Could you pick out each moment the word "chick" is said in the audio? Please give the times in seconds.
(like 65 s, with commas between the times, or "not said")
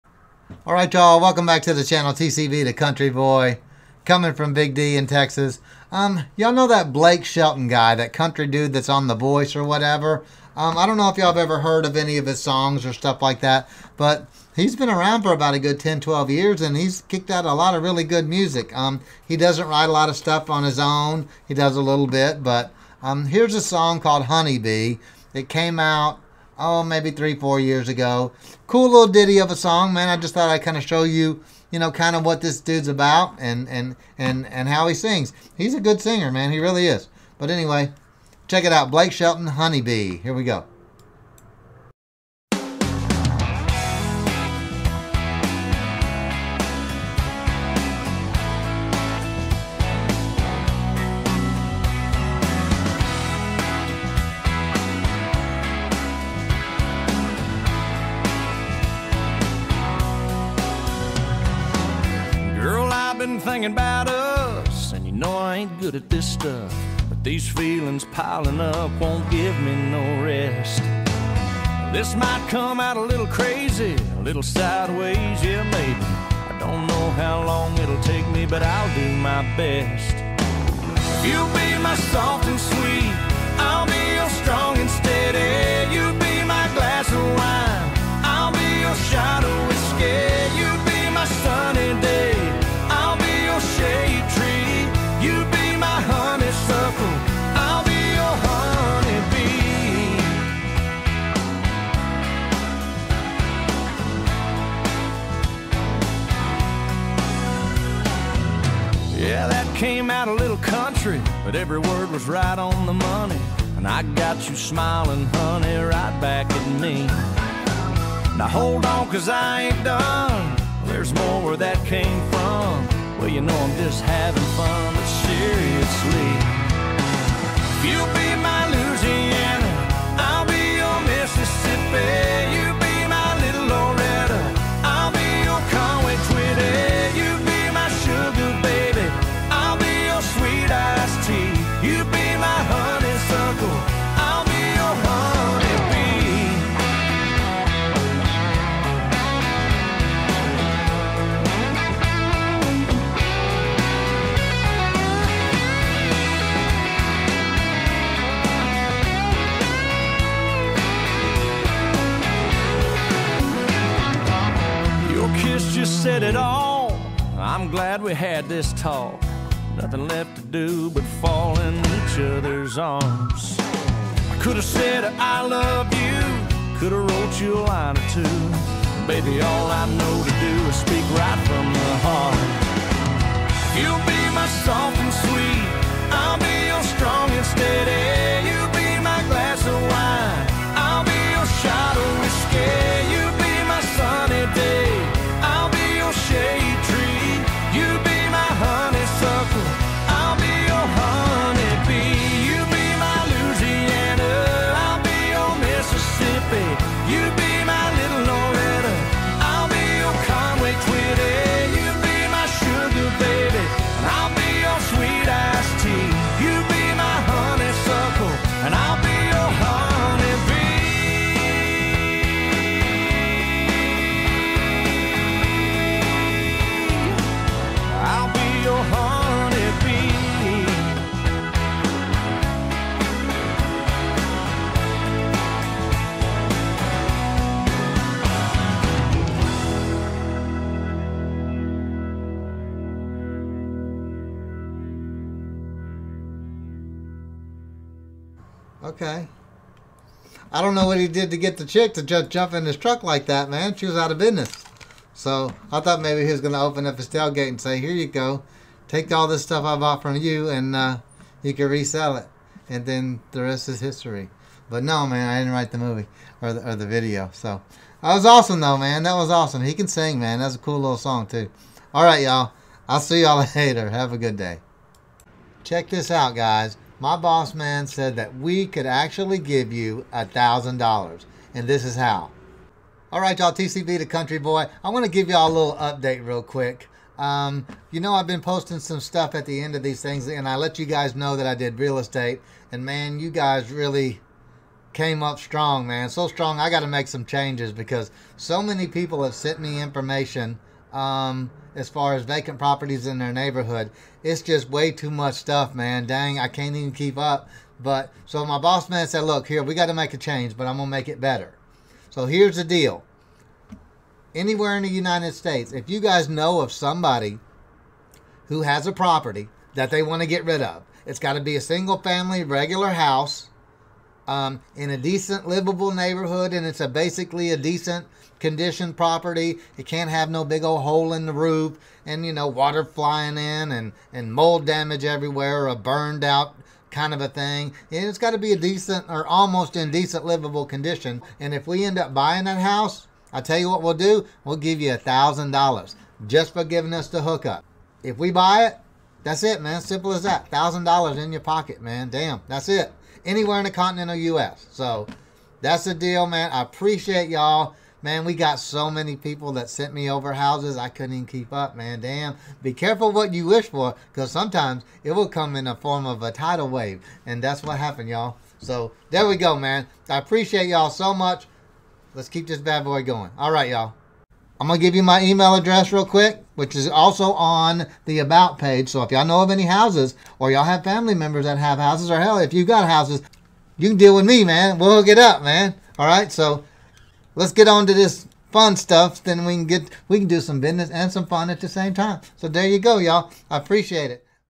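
251 s.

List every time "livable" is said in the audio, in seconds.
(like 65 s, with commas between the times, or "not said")
325 s, 340 s.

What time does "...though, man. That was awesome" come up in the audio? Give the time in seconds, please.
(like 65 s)
268 s.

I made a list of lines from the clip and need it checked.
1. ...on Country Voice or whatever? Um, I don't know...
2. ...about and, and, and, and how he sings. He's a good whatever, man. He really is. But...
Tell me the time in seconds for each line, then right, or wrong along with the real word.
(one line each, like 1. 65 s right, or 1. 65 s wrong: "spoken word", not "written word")
1. 8 s wrong: "The", not "Country"
2. 32 s wrong: "singer", not "whatever".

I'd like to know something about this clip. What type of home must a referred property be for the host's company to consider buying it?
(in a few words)
single family.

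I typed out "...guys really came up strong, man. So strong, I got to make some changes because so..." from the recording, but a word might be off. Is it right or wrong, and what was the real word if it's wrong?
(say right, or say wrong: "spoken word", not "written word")
right.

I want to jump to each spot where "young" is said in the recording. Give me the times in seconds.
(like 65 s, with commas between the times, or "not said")
not said.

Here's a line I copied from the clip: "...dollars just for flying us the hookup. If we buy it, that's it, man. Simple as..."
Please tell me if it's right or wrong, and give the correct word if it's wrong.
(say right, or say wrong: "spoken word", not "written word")
wrong: "giving", not "flying".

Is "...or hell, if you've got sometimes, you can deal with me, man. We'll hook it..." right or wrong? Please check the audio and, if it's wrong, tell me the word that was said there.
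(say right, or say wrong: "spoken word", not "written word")
wrong: "houses", not "sometimes".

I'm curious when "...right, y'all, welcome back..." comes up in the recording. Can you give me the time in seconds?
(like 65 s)
0 s.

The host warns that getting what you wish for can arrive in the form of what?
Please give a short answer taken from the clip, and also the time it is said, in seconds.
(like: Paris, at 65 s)
a tidal wave, at 366 s.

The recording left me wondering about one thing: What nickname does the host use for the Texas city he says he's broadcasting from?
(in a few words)
Big D.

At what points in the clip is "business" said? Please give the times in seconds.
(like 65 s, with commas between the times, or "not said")
254 s, 390 s.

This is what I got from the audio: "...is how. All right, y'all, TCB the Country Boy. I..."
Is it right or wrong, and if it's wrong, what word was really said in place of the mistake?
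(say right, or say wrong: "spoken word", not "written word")
right.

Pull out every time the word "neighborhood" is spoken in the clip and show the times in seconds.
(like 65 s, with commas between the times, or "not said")
303 s, 325 s.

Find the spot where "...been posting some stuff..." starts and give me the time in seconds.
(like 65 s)
288 s.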